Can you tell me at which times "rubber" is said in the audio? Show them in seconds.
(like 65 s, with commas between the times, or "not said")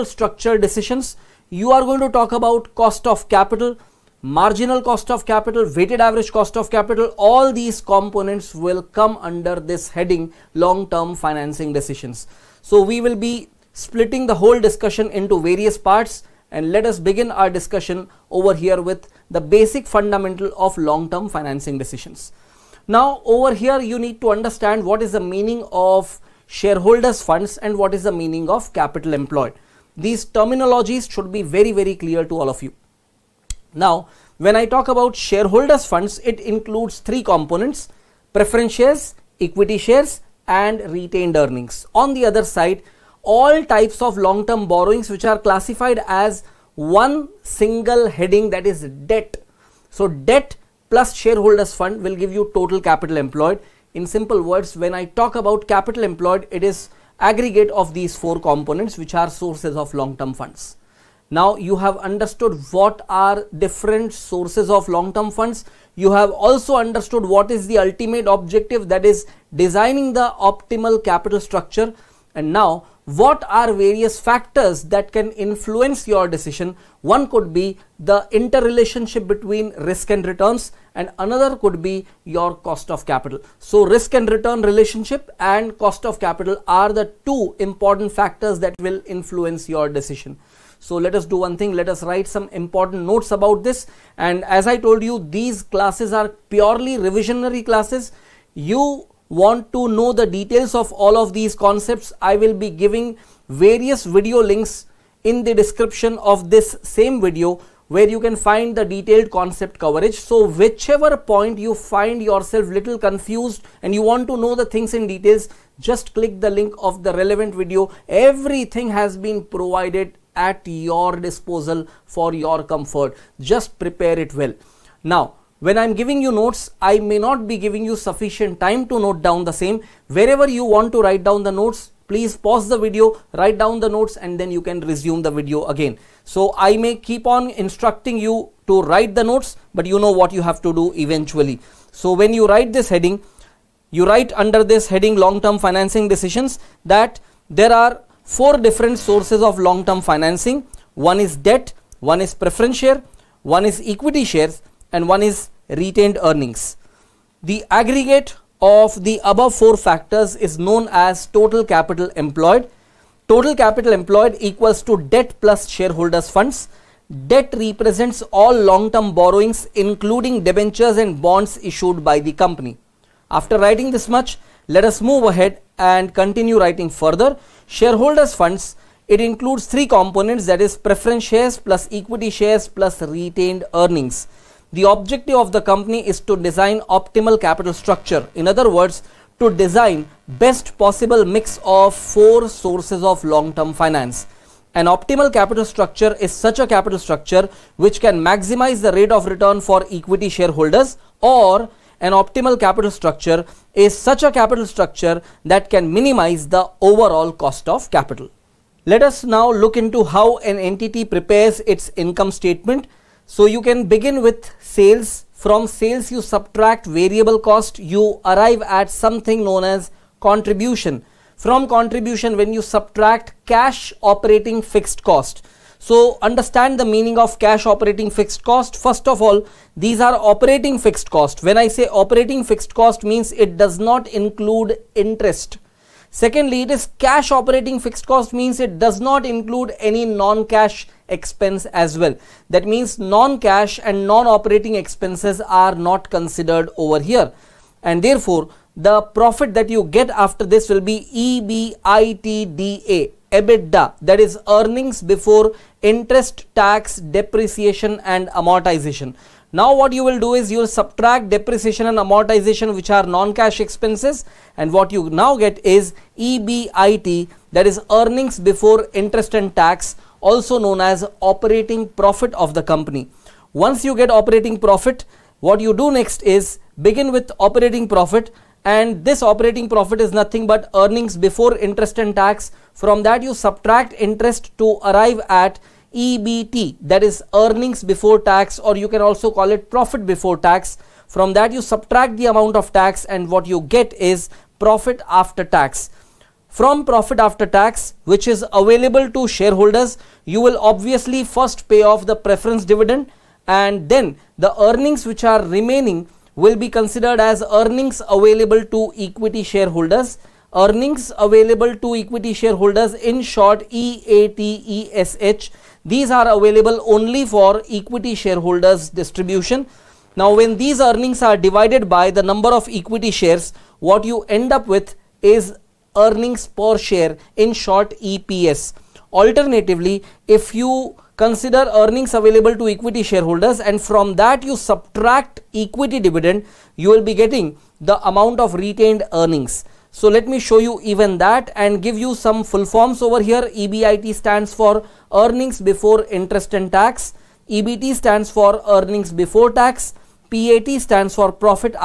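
not said.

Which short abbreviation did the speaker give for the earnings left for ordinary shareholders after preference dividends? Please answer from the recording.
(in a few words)
EATESH.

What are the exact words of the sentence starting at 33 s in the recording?
Now, when I talk about shareholders funds, it includes three components, preference shares, equity shares and retained earnings.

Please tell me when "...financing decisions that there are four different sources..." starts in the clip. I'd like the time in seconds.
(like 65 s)
145 s.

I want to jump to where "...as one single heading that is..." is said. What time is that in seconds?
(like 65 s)
46 s.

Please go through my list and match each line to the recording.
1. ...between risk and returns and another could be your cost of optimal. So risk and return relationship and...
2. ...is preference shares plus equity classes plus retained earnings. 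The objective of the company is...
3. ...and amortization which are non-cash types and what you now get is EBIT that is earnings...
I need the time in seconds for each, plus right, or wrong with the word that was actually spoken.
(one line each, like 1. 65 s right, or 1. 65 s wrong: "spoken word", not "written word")
1. 79 s wrong: "capital", not "optimal"
2. 180 s wrong: "shares", not "classes"
3. 261 s wrong: "expenses", not "types".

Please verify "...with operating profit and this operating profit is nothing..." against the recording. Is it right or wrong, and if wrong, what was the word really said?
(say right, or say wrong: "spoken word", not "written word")
right.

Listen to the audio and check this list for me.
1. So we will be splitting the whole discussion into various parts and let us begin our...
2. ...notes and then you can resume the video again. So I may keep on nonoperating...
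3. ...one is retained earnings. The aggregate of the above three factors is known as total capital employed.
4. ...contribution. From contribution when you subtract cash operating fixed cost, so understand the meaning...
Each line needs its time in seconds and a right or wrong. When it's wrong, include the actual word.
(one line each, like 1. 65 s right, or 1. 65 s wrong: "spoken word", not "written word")
1. 12 s right
2. 133 s wrong: "instructing", not "nonoperating"
3. 155 s wrong: "four", not "three"
4. 220 s right.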